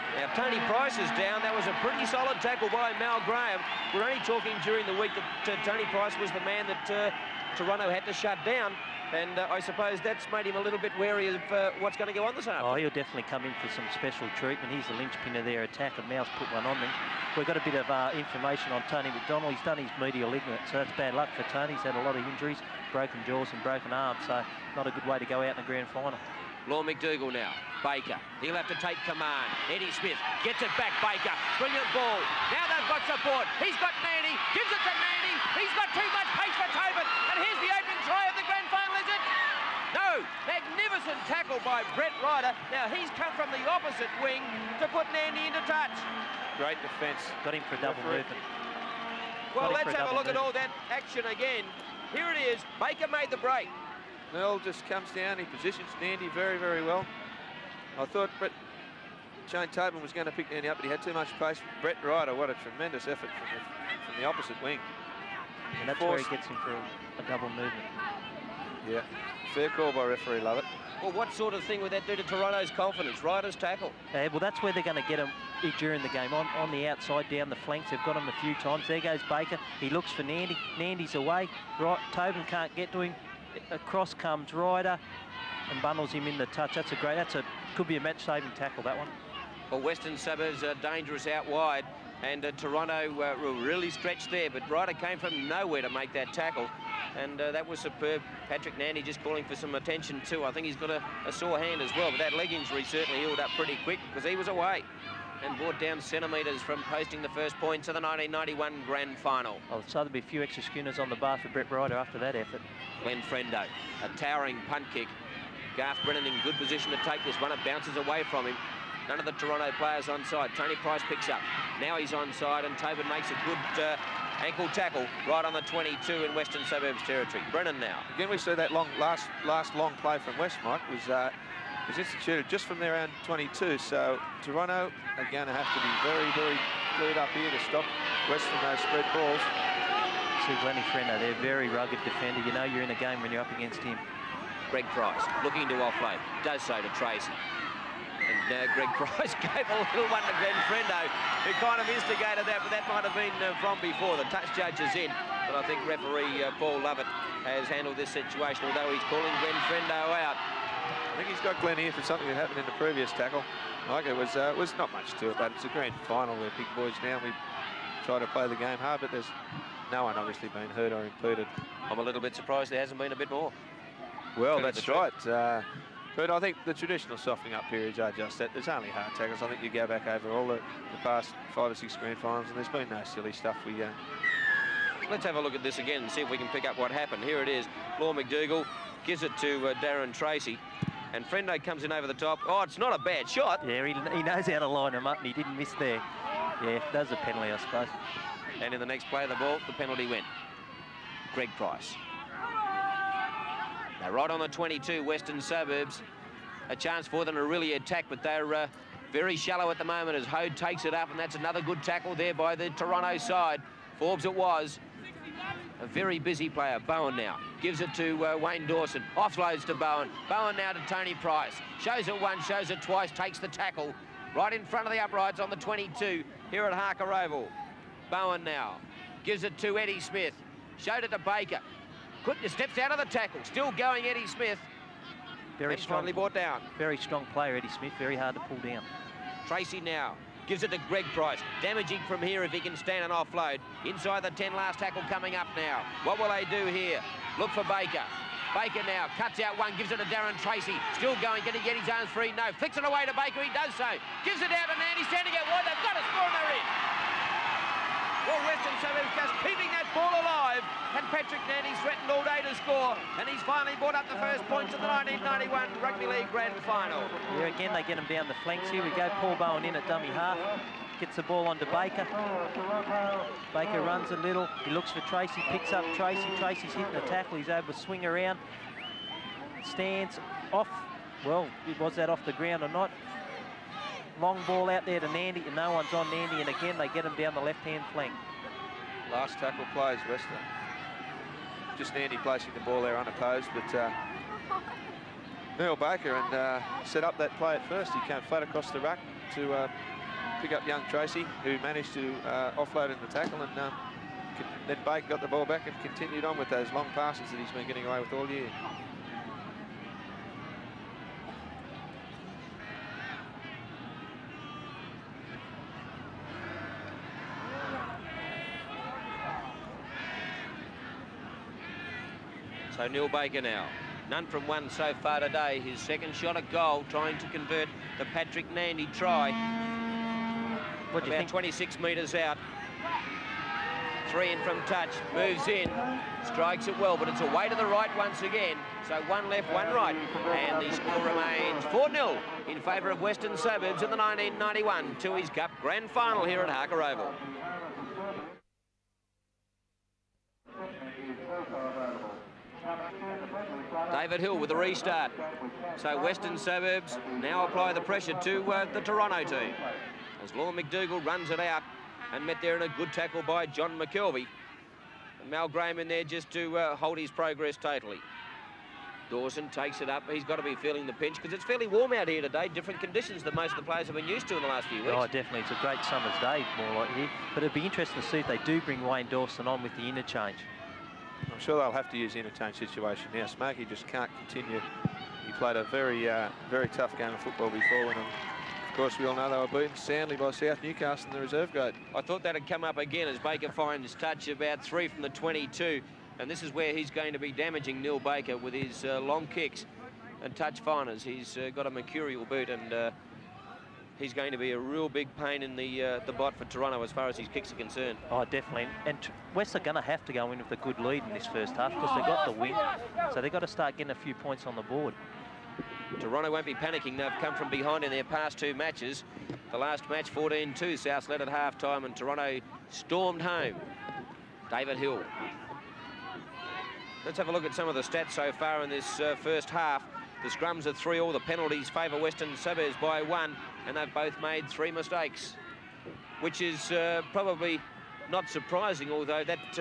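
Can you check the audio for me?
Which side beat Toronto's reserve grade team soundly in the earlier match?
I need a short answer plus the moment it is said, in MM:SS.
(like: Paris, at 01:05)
South Newcastle, at 06:30.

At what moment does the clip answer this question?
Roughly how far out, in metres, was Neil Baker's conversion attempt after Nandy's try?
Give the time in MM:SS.
05:31.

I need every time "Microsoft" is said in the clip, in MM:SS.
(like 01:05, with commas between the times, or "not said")
not said.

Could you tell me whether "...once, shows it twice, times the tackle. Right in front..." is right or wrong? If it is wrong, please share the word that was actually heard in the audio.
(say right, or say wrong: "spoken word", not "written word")
wrong: "takes", not "times".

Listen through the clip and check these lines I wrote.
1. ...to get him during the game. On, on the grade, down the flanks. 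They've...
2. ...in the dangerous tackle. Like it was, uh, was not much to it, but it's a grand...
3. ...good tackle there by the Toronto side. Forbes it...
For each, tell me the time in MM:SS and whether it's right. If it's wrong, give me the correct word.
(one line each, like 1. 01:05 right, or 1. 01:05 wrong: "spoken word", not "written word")
1. 01:15 wrong: "outside", not "grade"
2. 02:42 wrong: "previous", not "dangerous"
3. 03:31 right.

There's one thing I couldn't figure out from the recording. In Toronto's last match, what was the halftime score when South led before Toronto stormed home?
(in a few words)
14-2.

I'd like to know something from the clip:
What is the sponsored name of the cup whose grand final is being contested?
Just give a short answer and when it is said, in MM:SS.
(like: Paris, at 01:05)
Tooheys Cup, at 05:45.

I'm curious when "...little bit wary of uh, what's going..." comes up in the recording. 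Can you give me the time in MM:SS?
00:10.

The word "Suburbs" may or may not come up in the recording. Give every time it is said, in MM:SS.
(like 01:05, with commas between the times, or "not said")
01:30, 02:06, 03:25, 04:18, 05:43, 05:56, 07:12.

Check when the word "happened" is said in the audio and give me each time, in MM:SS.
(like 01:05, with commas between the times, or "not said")
02:42, 03:06.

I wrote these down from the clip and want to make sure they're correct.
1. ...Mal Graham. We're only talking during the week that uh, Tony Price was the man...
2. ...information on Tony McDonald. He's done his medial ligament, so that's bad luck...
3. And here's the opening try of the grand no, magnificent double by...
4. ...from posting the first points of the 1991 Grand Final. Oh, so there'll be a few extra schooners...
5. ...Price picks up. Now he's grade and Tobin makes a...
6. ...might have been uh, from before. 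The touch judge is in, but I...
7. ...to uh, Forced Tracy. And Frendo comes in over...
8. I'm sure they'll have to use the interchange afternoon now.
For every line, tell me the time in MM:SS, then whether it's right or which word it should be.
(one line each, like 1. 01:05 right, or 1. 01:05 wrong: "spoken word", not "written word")
1. 00:03 right
2. 00:18 right
3. 00:37 wrong: "tackle", not "double"
4. 01:46 right
5. 02:00 wrong: "onside", not "grade"
6. 02:32 right
7. 03:09 wrong: "Darren", not "Forced"
8. 06:21 wrong: "situation", not "afternoon".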